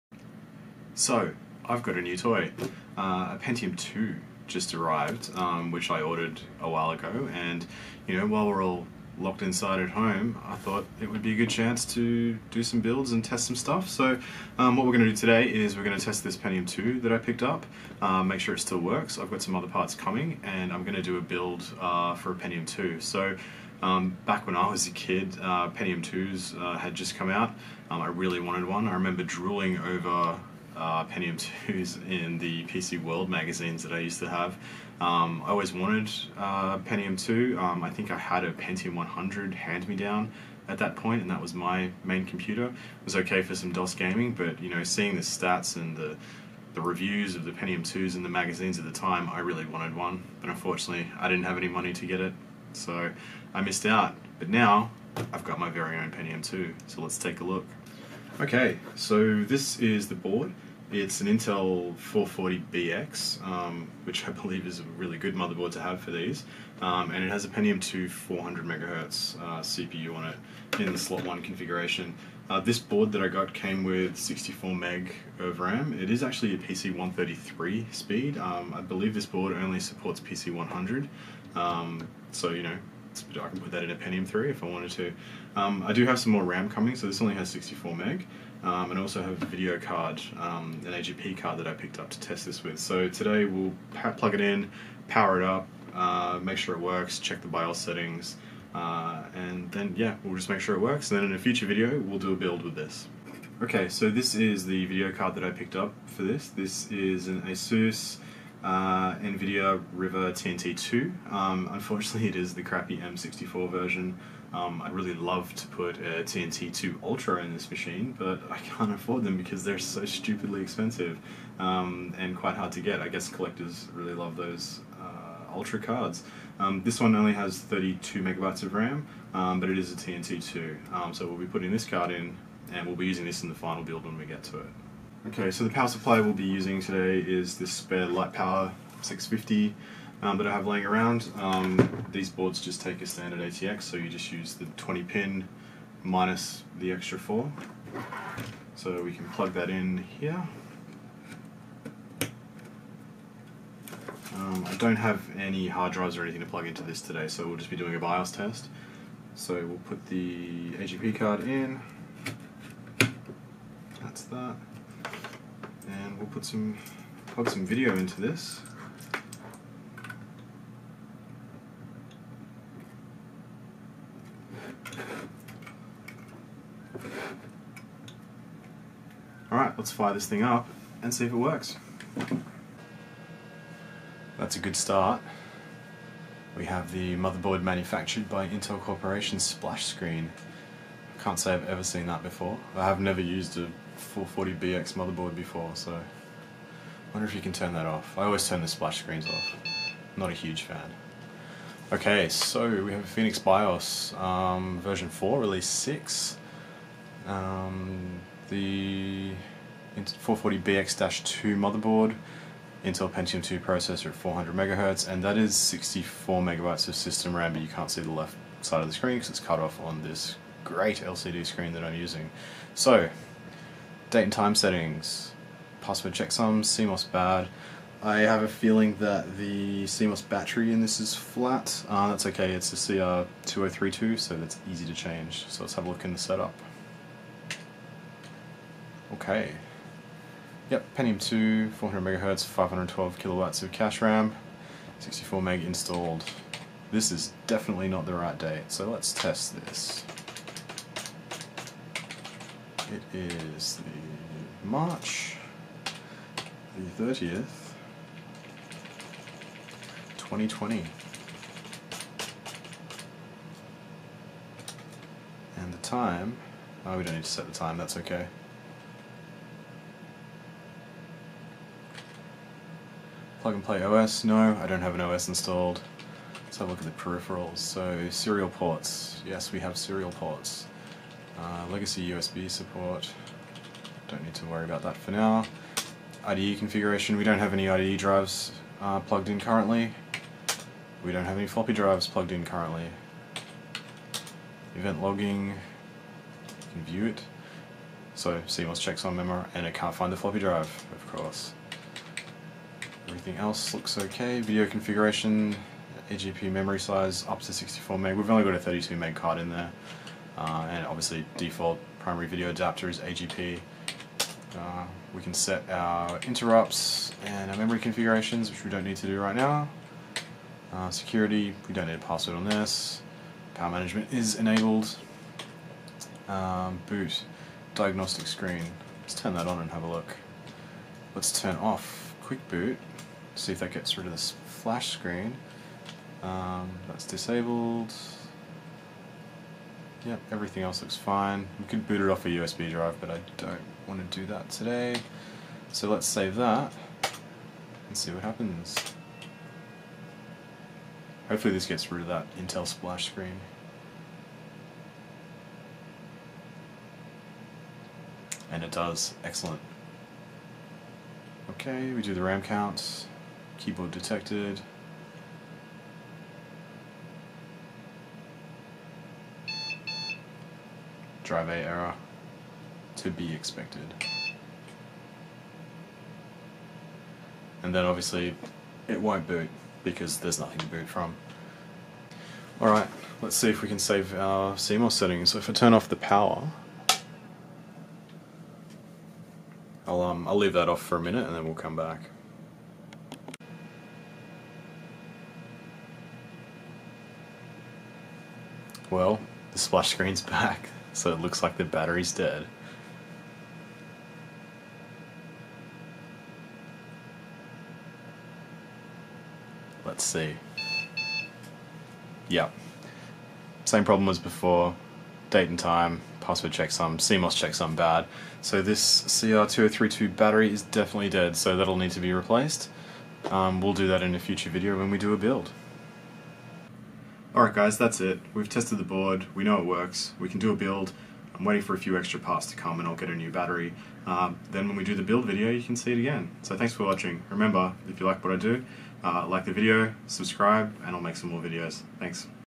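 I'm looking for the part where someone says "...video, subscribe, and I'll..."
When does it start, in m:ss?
7:19.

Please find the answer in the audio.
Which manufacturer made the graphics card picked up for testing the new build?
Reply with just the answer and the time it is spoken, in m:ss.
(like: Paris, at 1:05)
ASUS, at 1:47.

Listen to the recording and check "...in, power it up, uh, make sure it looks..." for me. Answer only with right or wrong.
wrong.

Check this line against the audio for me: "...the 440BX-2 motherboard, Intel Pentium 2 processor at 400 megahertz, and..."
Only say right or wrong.
right.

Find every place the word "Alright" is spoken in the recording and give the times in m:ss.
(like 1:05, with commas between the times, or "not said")
2:59, 6:22, 7:07.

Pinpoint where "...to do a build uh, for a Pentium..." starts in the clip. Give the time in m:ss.
0:20.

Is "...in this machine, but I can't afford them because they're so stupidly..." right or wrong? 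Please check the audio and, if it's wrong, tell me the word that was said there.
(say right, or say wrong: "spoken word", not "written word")
right.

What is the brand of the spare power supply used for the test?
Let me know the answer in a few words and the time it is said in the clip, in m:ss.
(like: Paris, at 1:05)
Litepower, at 2:18.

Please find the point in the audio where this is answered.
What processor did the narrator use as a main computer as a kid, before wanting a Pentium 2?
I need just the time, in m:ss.
0:38.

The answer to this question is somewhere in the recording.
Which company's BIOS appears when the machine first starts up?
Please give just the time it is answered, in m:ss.
3:23.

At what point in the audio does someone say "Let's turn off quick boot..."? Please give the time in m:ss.
5:31.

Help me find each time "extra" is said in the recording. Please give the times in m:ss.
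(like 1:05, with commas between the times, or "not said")
2:26, 7:11.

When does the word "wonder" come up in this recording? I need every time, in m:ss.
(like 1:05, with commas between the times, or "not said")
3:17.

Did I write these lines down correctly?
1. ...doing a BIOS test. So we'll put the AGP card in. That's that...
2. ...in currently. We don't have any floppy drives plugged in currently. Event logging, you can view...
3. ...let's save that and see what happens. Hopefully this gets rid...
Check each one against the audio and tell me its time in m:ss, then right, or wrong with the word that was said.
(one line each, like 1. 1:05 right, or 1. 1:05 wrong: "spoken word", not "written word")
1. 2:37 right
2. 4:49 right
3. 5:45 right.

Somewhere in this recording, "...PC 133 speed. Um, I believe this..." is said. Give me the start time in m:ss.
1:16.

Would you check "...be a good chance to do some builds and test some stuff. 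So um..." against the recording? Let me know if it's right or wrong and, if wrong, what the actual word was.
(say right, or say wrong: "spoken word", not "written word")
right.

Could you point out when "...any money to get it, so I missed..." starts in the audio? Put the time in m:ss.
0:51.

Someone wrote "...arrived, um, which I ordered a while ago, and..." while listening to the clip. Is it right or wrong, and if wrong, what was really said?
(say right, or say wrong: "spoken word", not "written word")
right.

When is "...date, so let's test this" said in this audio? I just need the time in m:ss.
4:08.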